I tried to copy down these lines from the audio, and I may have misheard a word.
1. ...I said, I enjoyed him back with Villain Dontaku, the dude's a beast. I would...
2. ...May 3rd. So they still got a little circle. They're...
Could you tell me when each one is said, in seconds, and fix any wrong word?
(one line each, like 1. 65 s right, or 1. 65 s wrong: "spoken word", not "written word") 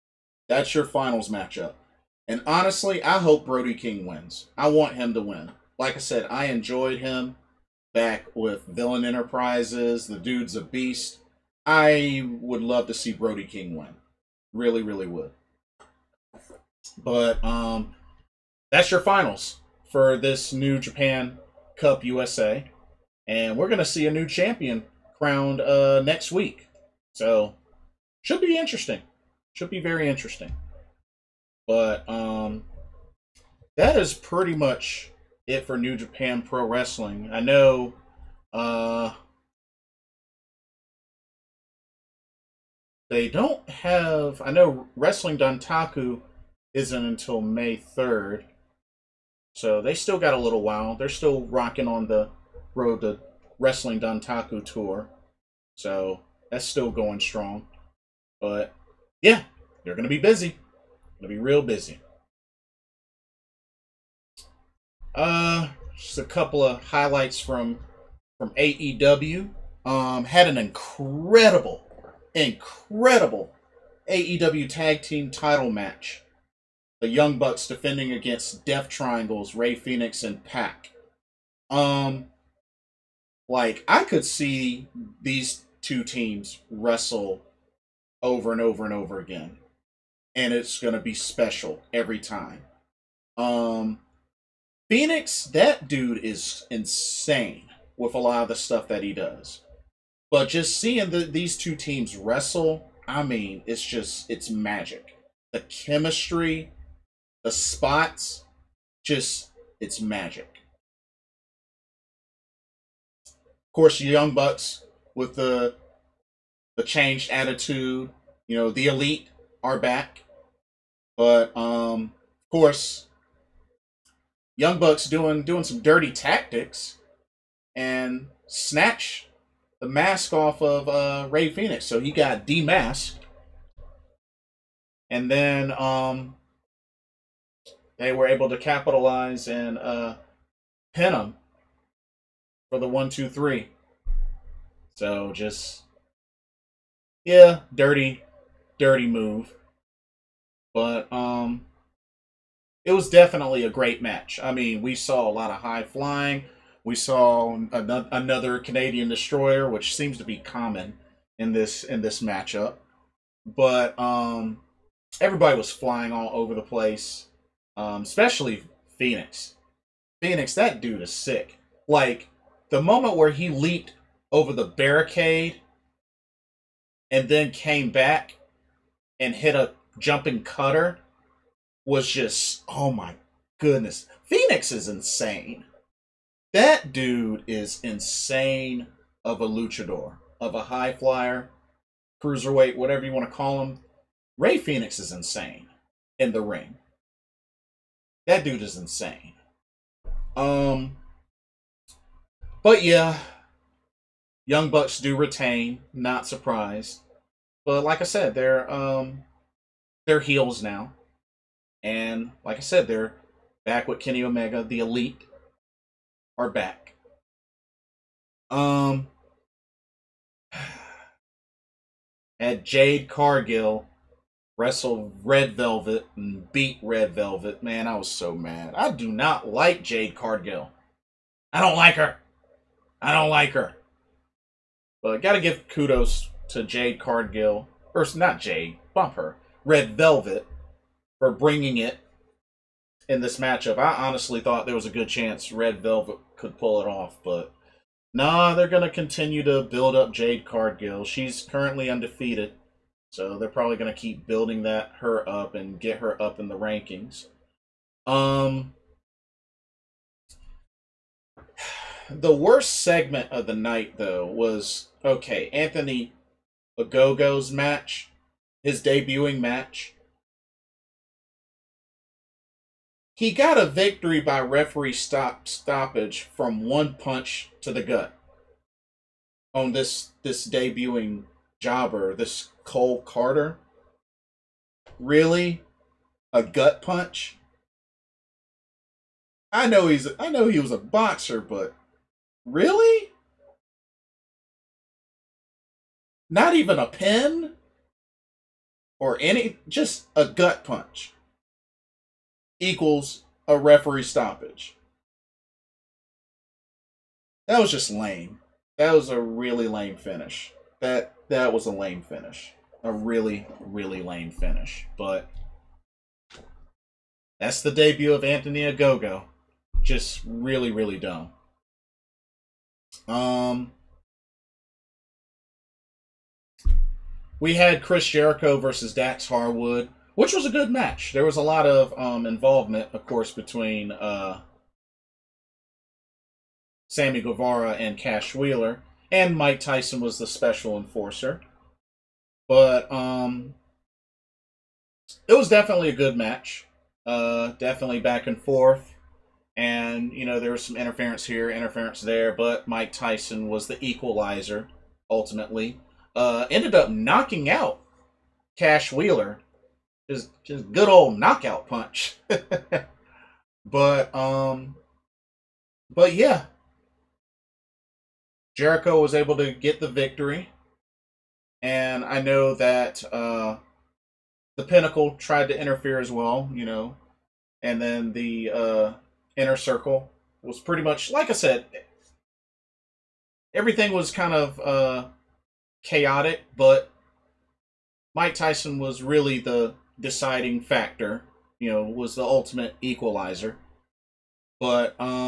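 1. 5 s wrong: "Enterprises", not "Dontaku"
2. 47 s wrong: "while", not "circle".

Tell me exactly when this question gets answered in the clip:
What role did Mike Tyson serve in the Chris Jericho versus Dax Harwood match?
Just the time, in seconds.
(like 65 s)
340 s.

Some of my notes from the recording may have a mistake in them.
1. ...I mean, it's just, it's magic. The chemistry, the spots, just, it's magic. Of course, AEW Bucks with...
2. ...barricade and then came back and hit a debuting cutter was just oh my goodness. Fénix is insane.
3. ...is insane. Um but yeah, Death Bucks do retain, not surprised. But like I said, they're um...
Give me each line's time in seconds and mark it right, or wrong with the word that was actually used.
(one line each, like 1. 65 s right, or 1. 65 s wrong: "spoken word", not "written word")
1. 103 s wrong: "Young", not "AEW"
2. 174 s wrong: "jumping", not "debuting"
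3. 198 s wrong: "Young", not "Death".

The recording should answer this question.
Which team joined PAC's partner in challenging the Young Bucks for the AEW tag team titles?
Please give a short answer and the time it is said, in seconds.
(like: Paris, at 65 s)
Death Triangles, at 78 s.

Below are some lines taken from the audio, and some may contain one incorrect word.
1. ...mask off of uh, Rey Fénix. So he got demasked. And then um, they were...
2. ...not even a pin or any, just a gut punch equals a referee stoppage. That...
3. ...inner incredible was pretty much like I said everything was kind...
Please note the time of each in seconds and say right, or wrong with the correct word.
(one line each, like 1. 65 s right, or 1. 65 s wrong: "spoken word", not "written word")
1. 129 s right
2. 296 s right
3. 379 s wrong: "circle", not "incredible".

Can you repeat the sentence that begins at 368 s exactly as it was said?
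Jericho was able to get the victory.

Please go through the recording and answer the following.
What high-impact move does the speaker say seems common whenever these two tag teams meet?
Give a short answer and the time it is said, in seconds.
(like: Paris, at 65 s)
Canadian destroyer, at 158 s.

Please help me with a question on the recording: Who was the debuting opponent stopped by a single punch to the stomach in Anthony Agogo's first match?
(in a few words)
Cole Carter.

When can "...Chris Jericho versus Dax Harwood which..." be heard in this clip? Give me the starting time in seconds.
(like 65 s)
327 s.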